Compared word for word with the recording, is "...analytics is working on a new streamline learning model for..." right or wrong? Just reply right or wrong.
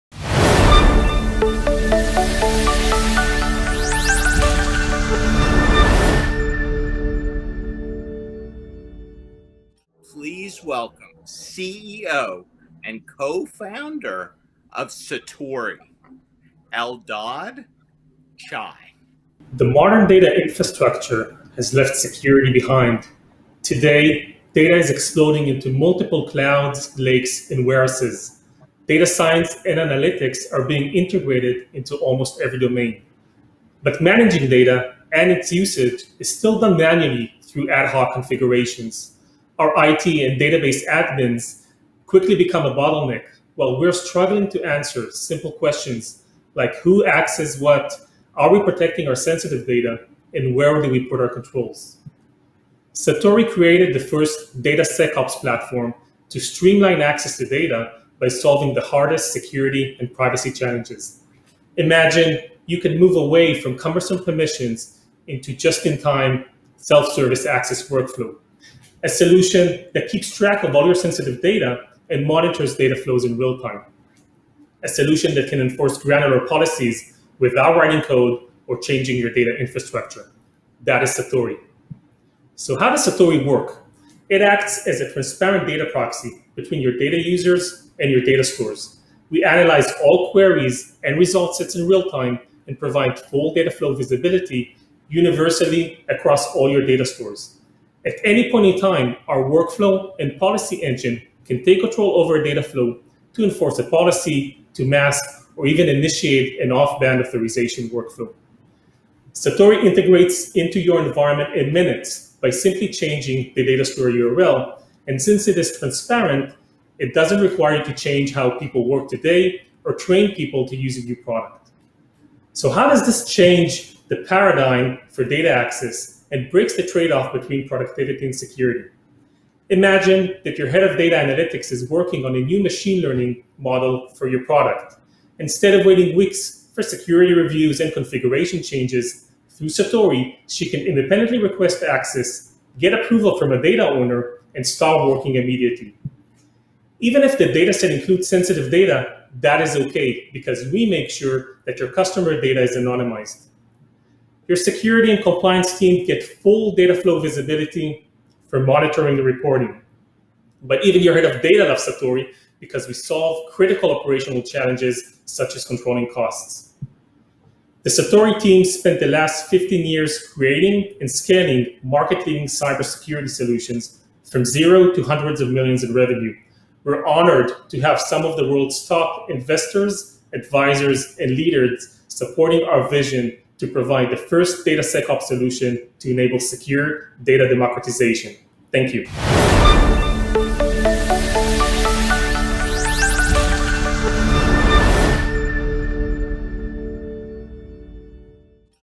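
wrong.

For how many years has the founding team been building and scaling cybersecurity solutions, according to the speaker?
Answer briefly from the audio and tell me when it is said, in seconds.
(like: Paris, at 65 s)
15, at 169 s.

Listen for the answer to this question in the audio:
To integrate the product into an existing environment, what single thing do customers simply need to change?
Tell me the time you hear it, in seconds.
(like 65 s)
113 s.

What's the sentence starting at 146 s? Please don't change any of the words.
Even if the dataset includes sensitive data, that is okay because we make sure that your customer data is anonymized.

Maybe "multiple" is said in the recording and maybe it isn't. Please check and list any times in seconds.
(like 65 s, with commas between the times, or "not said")
25 s.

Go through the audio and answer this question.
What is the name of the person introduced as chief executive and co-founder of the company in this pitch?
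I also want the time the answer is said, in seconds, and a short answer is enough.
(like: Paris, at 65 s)
Eldad Chai, at 16 s.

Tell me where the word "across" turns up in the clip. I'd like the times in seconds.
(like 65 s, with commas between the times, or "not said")
96 s.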